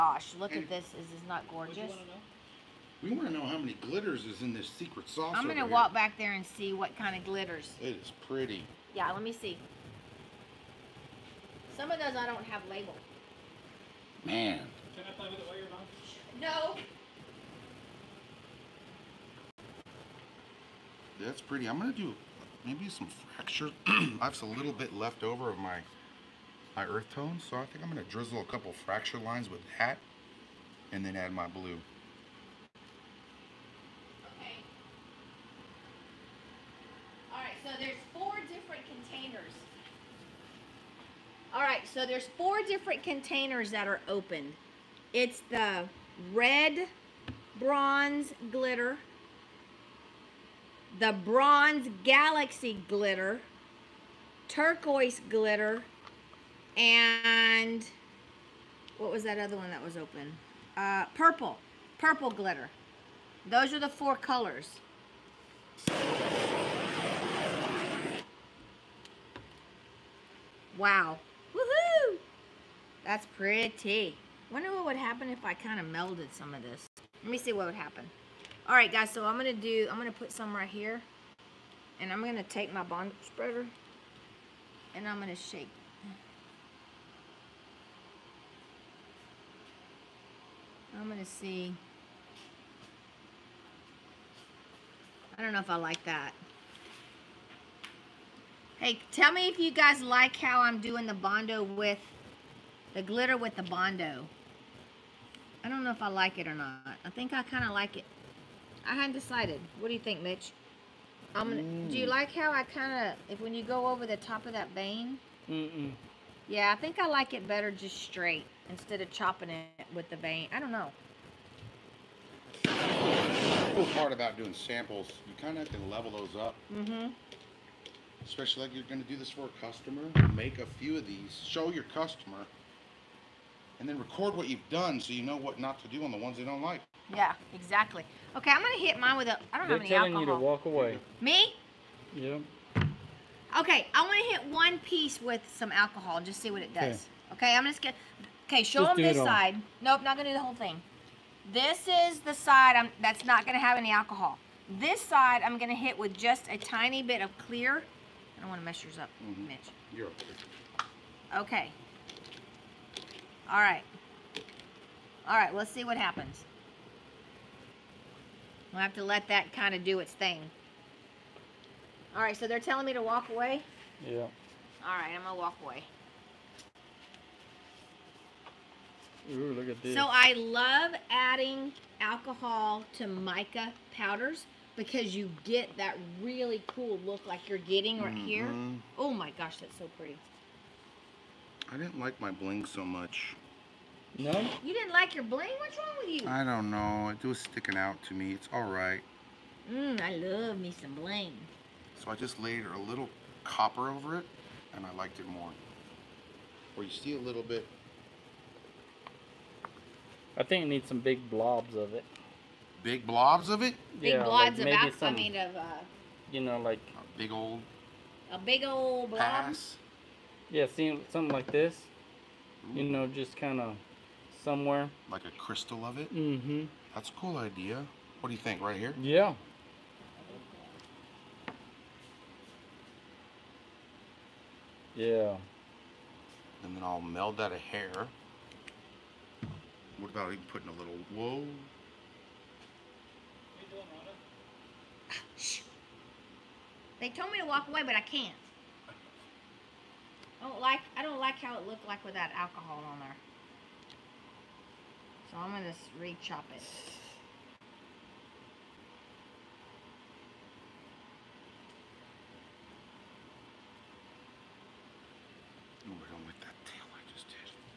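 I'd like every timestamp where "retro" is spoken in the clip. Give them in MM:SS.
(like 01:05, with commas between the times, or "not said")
not said.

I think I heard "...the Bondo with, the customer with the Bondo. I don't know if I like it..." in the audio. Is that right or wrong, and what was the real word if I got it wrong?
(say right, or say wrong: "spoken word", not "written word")
wrong: "glitter", not "customer".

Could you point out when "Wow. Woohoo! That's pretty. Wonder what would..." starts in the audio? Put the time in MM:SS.
01:10.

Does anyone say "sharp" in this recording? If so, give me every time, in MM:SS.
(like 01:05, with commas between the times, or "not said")
not said.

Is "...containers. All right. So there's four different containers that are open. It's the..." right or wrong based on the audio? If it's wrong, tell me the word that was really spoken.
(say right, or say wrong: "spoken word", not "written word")
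right.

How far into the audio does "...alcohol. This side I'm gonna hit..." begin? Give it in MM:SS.
02:33.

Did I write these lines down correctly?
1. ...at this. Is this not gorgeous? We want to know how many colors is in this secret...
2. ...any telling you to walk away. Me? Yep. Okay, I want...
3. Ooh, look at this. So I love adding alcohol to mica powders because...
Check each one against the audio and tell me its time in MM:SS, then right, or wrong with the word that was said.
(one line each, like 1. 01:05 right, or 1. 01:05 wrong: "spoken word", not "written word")
1. 00:00 wrong: "glitters", not "colors"
2. 02:19 right
3. 02:59 right.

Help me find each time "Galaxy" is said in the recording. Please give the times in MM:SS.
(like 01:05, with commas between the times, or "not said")
00:52.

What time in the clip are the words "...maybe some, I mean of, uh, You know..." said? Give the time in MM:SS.
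03:34.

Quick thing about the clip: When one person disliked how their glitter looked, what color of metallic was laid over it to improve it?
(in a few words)
Copper.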